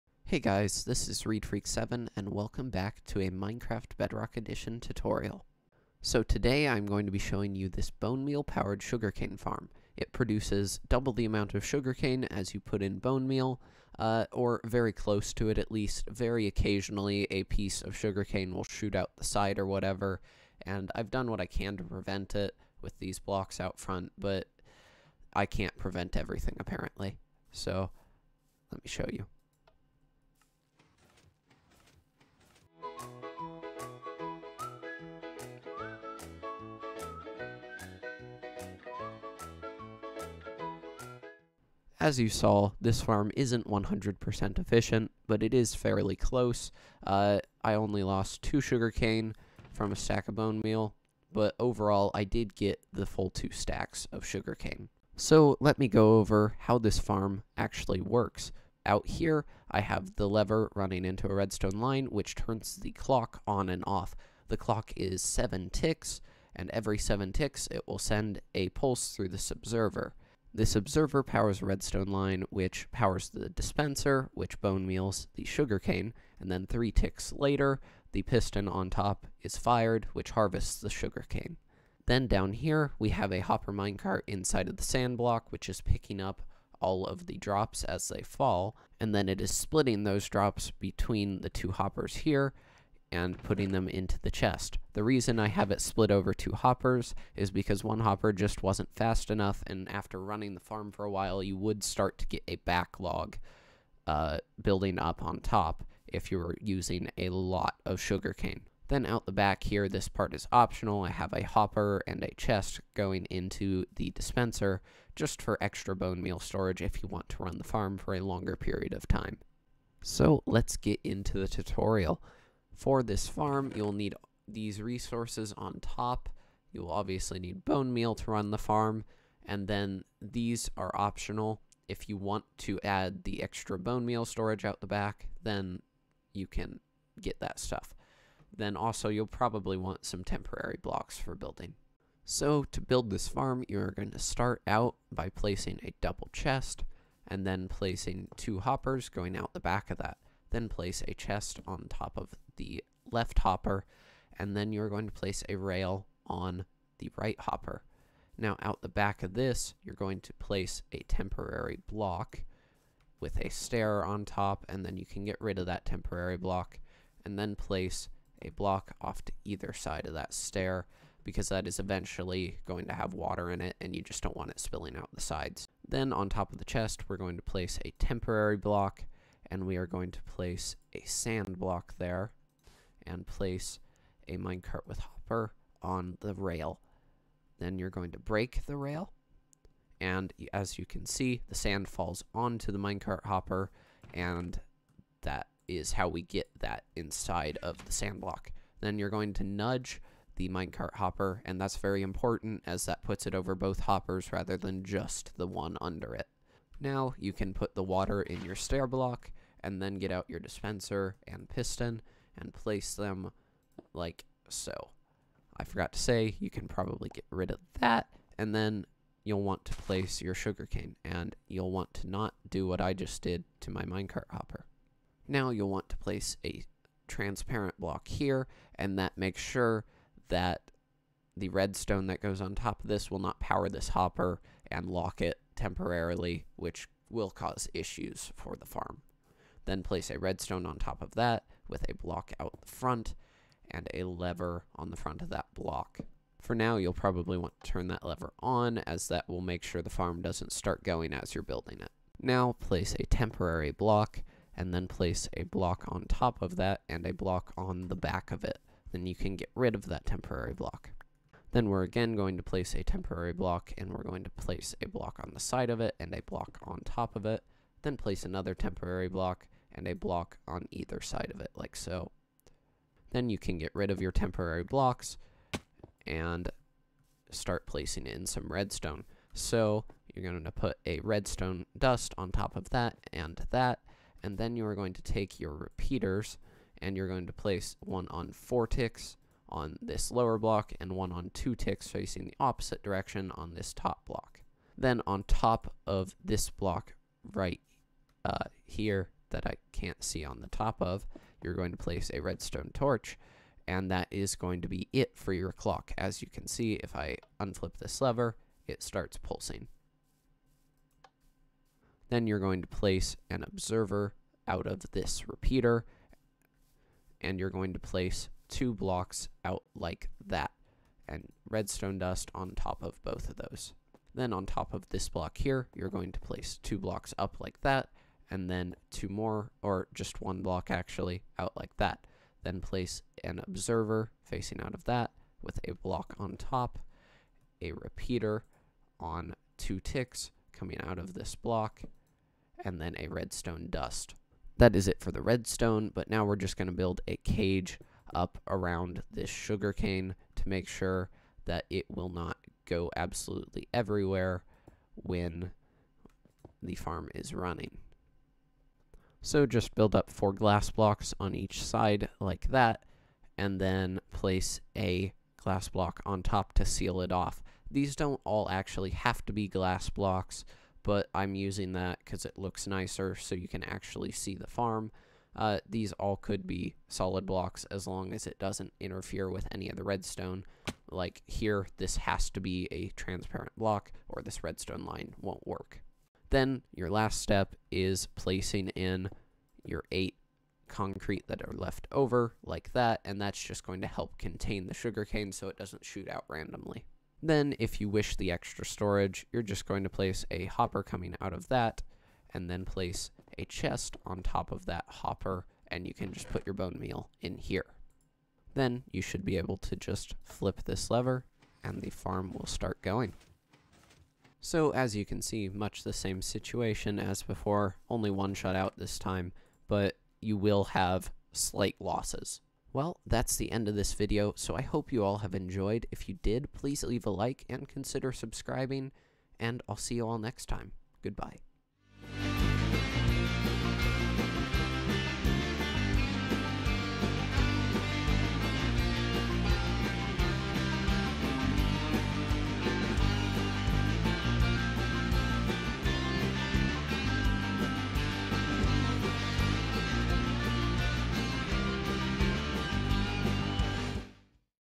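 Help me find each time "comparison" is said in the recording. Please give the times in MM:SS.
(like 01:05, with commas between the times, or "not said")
not said.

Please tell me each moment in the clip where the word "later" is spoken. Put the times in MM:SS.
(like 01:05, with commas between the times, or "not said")
01:17.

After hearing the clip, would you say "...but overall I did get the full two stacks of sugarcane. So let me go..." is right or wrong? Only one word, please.
right.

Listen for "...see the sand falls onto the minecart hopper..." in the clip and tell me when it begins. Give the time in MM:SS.
03:11.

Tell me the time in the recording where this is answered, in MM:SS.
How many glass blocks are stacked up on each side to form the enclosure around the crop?
06:00.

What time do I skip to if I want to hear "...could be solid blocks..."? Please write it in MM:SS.
06:16.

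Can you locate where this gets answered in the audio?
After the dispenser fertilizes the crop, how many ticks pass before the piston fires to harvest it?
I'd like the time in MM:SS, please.
01:16.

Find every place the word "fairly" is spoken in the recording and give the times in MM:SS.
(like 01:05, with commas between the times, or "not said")
00:45.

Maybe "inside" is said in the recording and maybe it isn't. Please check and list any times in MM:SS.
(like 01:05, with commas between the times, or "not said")
01:24, 03:16.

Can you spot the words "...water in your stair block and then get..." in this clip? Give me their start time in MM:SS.
03:27.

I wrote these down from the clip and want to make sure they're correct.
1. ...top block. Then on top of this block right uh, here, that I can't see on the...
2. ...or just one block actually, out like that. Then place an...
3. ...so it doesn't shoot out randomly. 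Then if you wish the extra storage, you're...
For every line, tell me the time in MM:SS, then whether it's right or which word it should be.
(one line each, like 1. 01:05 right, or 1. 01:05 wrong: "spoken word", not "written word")
1. 04:53 right
2. 05:29 right
3. 06:35 right.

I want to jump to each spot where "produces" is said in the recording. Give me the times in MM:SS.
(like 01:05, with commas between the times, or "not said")
00:10.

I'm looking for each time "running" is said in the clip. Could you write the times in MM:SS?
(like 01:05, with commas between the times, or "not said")
01:00, 01:40, 05:57.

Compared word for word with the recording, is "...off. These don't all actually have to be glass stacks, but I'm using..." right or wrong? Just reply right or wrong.
wrong.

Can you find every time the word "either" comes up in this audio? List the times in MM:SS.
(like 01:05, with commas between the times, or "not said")
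02:49, 04:30.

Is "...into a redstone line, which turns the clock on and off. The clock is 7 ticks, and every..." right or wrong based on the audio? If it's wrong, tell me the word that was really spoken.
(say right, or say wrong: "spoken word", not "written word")
right.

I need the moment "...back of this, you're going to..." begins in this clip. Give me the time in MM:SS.
02:38.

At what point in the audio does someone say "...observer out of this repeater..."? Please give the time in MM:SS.
05:13.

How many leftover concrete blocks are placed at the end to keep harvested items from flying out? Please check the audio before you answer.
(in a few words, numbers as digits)
8.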